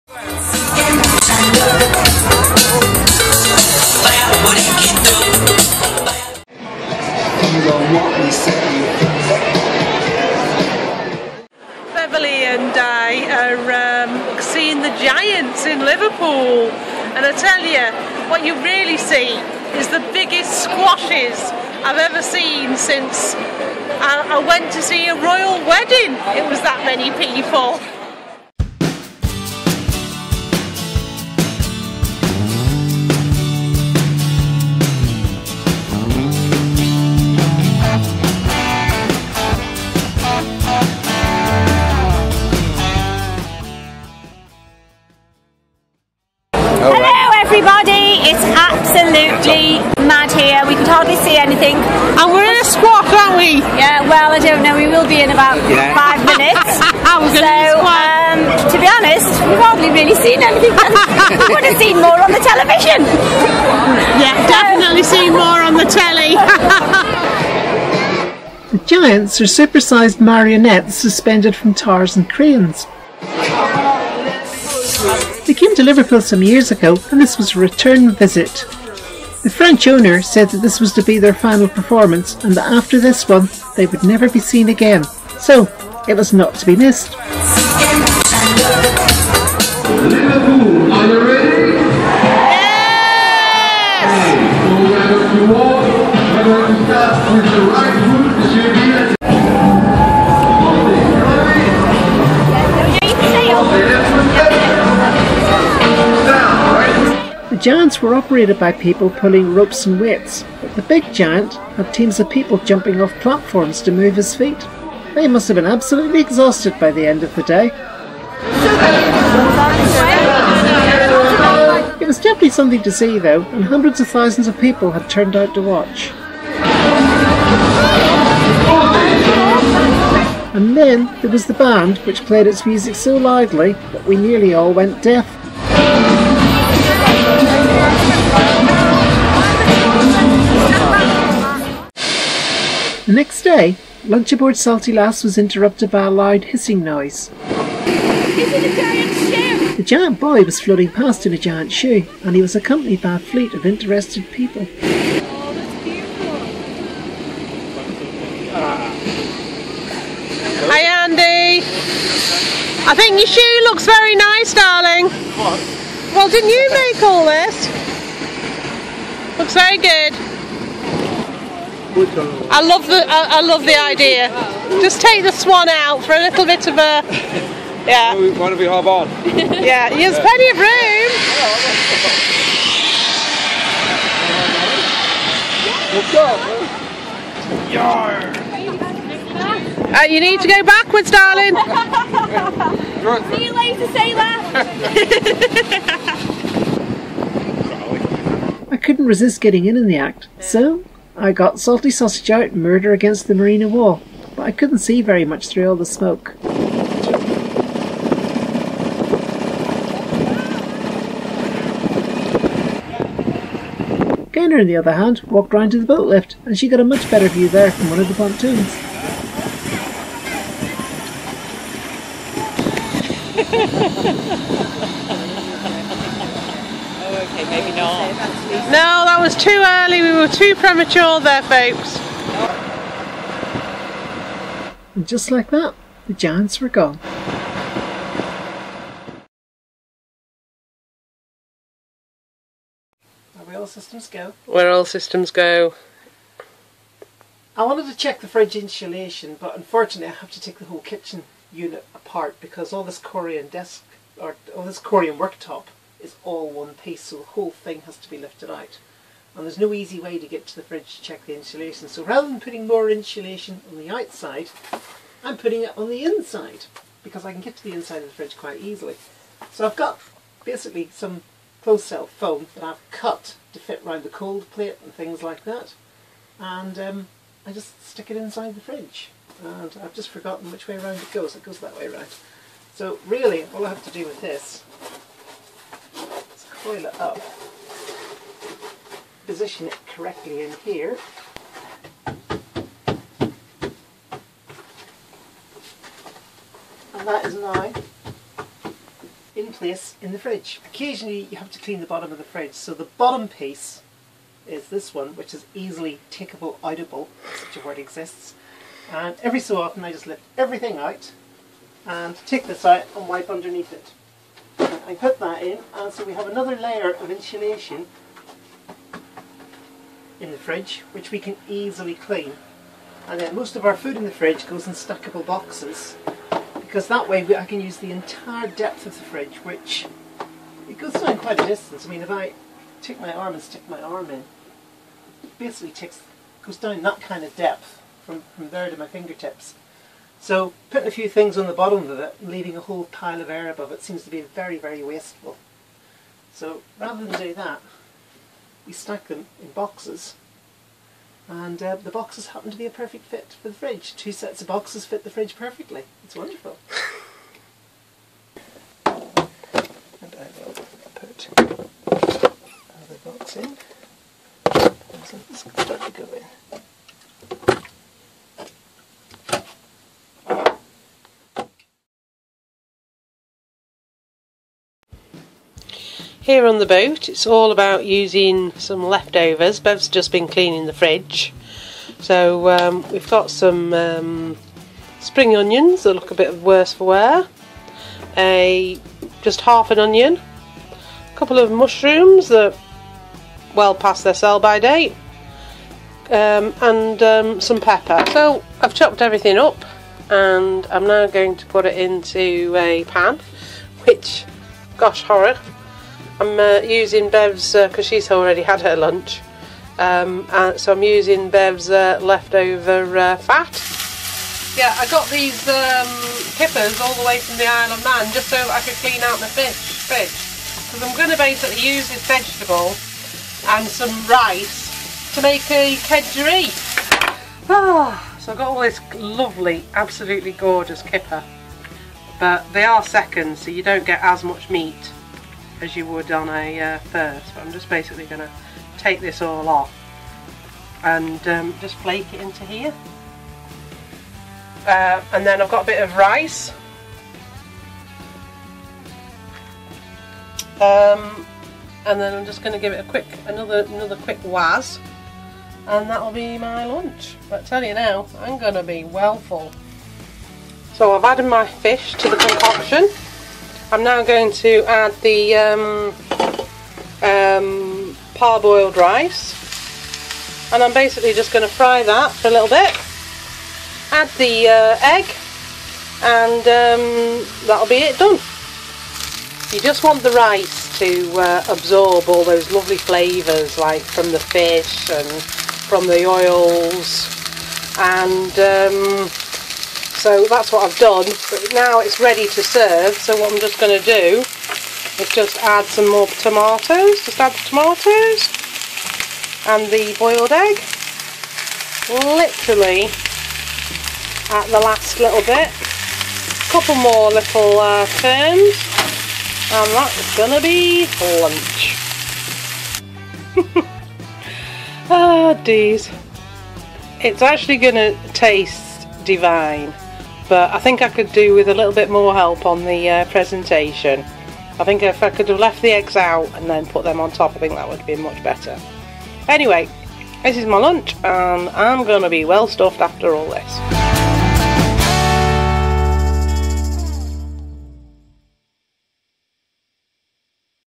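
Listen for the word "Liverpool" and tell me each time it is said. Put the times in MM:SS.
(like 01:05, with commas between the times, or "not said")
01:15, 01:30.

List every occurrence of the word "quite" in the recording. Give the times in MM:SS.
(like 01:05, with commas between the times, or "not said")
04:28, 05:31.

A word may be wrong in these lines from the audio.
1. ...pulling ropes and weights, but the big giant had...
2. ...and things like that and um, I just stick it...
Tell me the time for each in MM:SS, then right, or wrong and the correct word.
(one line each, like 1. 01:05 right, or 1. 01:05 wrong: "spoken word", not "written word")
1. 01:49 right
2. 04:34 right.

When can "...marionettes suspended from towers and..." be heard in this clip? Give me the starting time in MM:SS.
01:10.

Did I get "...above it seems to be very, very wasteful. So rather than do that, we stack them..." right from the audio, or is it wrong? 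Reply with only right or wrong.
right.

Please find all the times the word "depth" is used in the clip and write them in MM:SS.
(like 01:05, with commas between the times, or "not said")
05:28, 05:37.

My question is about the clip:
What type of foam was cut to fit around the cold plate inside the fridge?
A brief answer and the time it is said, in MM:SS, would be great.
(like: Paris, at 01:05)
Closed cell foam, at 04:31.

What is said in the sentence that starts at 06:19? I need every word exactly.
Bev's just been cleaning the fridge.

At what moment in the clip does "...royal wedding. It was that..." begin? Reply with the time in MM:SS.
00:25.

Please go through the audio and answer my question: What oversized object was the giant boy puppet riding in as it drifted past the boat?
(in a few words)
A giant shoe.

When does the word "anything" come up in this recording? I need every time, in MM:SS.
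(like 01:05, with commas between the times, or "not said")
00:51, 01:00.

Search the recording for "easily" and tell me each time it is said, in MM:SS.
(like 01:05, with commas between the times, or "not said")
04:28, 05:05, 05:21.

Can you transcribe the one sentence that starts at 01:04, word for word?
yeah, definitely seen more on the telly.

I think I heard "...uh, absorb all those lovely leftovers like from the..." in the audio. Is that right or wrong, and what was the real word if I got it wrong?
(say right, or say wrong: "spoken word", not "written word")
wrong: "flavours", not "leftovers".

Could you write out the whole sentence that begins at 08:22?
Literally at the last little bit.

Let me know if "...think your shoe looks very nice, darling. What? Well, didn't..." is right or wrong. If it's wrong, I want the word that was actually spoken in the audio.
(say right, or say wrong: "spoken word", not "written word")
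right.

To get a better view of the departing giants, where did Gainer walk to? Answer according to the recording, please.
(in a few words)
The boat lift.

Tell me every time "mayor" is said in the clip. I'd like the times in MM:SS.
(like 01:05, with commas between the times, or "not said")
not said.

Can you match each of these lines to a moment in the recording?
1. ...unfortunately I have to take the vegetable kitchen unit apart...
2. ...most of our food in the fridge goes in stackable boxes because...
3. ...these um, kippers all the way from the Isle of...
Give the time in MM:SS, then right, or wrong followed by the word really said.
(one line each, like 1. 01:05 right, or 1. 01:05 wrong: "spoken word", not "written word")
1. 04:09 wrong: "whole", not "vegetable"
2. 05:23 right
3. 06:55 right.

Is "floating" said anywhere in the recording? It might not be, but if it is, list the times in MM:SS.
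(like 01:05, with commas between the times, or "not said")
02:30.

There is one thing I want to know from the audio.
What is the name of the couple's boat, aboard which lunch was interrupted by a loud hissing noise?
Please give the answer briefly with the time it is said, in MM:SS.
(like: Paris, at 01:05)
Salty Lass, at 02:24.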